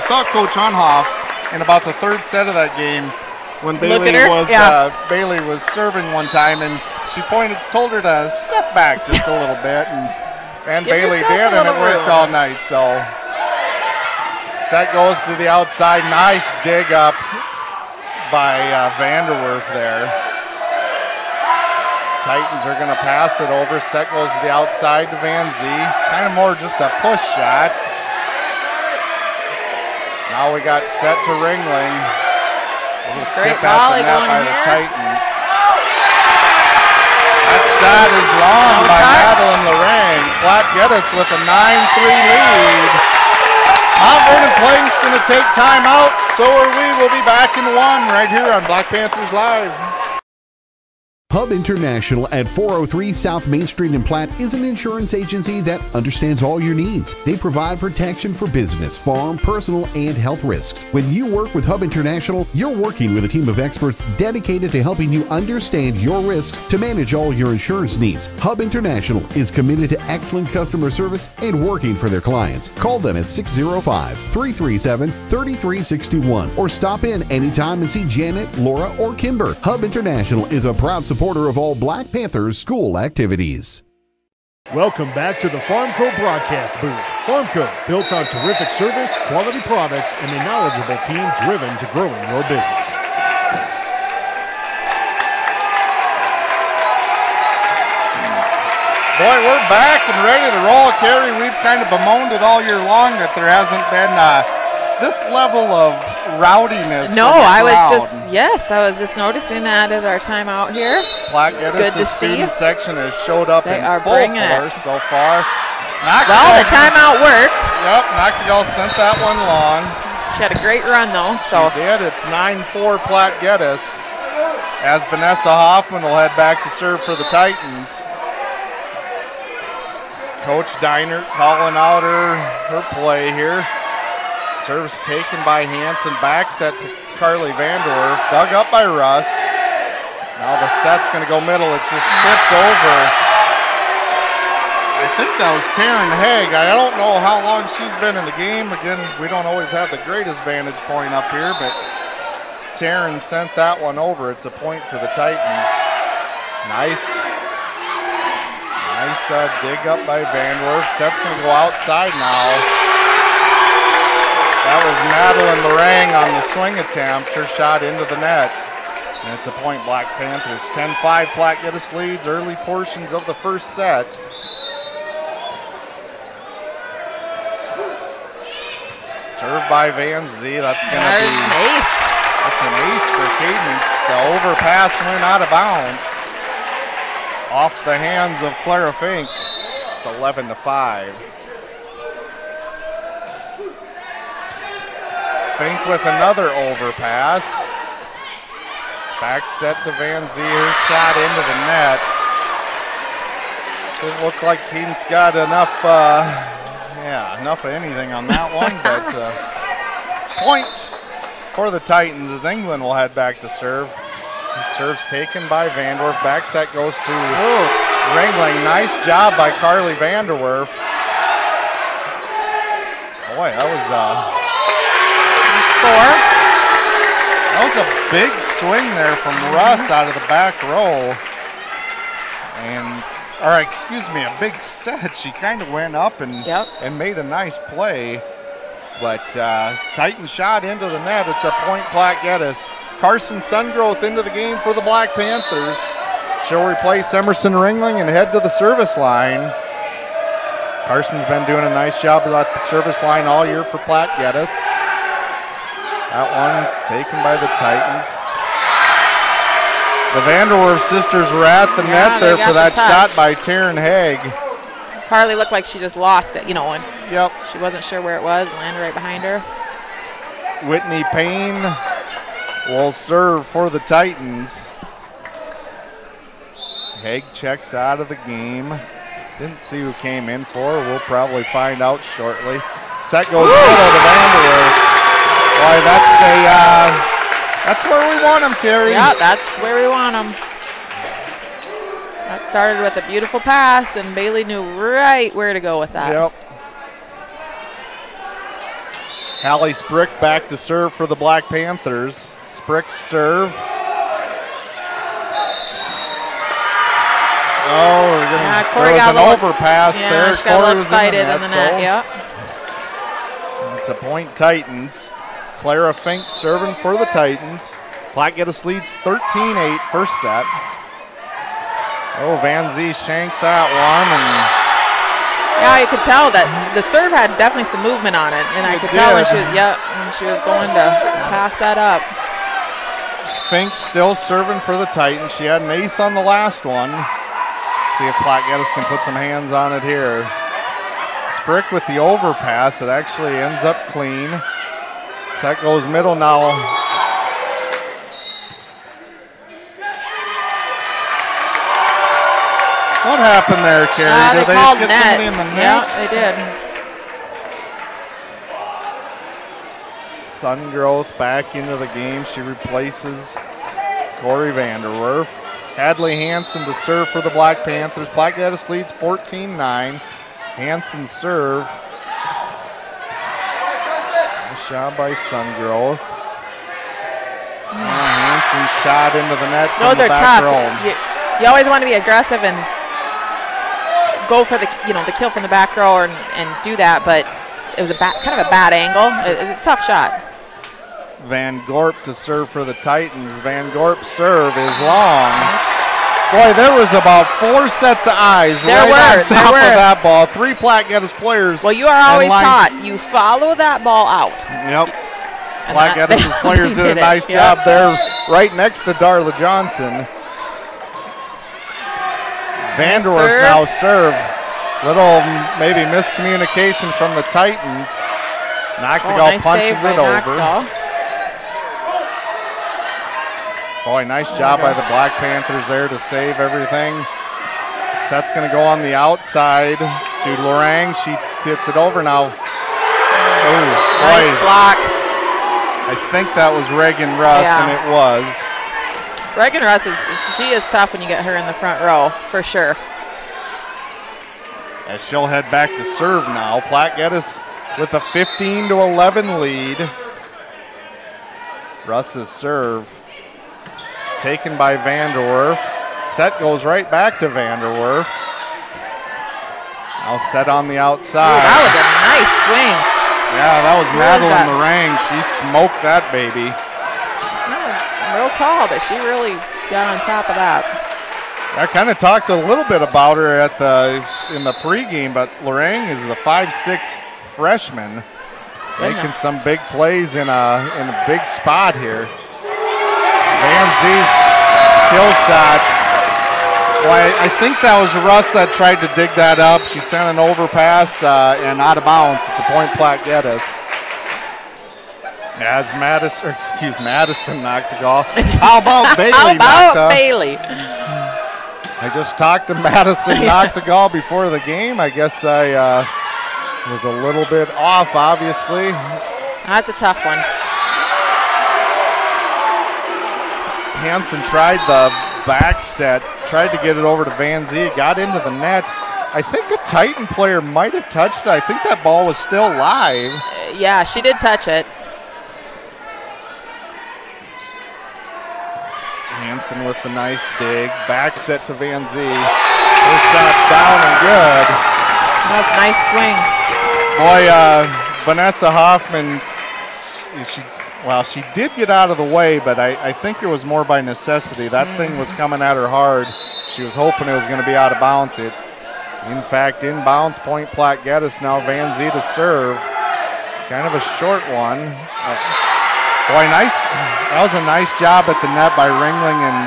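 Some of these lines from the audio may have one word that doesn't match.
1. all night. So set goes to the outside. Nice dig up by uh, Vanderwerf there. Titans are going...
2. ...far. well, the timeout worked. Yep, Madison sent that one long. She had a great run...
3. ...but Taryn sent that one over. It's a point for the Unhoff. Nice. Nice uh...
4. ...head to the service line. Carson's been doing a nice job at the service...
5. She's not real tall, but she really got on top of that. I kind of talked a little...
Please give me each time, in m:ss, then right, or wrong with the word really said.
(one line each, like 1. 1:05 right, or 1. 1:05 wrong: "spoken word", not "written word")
1. 0:12 right
2. 1:55 wrong: "Noctigal", not "Madison"
3. 2:31 wrong: "Titans", not "Unhoff"
4. 4:08 right
5. 7:47 right.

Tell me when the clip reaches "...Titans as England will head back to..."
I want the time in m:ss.
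3:31.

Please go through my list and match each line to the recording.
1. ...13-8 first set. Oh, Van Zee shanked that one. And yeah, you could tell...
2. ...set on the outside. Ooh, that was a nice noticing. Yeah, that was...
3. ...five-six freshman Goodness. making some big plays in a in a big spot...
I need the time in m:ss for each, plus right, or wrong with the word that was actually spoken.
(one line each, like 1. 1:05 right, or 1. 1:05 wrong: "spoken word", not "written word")
1. 5:19 right
2. 7:40 wrong: "swing", not "noticing"
3. 7:56 right.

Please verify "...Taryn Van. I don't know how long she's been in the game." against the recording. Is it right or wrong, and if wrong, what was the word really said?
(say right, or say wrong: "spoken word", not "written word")
wrong: "Haig", not "Van".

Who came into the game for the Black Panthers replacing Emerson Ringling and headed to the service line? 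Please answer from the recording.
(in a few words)
Carson Sungrowth.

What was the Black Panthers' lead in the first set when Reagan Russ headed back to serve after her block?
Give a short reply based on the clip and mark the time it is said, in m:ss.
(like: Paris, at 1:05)
15-11, at 7:28.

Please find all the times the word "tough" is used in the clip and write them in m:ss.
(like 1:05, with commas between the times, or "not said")
6:20, 6:29, 7:20, 8:29.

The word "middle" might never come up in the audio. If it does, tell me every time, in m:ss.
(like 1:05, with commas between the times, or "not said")
2:21, 5:45.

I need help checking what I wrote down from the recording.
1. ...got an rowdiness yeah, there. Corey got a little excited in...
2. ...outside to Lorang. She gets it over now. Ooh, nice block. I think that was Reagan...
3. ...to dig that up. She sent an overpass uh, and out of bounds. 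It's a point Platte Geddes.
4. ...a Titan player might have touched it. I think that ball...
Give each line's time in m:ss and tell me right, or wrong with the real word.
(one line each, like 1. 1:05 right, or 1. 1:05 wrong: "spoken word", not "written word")
1. 5:09 wrong: "overpass", not "rowdiness"
2. 7:08 right
3. 8:08 right
4. 8:39 right.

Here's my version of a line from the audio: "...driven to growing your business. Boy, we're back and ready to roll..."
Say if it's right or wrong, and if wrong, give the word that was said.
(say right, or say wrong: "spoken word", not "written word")
right.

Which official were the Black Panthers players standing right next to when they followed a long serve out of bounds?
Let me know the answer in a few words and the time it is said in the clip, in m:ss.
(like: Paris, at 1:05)
Darla Johnson, at 6:48.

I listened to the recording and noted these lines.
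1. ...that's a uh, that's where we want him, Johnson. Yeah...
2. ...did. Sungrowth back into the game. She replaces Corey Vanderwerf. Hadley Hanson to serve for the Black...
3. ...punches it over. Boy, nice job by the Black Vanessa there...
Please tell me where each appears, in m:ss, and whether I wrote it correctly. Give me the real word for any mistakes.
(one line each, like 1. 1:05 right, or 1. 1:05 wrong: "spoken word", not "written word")
1. 4:45 wrong: "Carrie", not "Johnson"
2. 6:00 right
3. 6:59 wrong: "Panthers", not "Vanessa".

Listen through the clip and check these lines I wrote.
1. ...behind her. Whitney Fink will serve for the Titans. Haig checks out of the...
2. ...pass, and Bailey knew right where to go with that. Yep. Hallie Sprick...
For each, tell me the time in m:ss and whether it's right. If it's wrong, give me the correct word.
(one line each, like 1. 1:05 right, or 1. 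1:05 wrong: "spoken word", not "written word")
1. 4:28 wrong: "Payne", not "Fink"
2. 4:53 right.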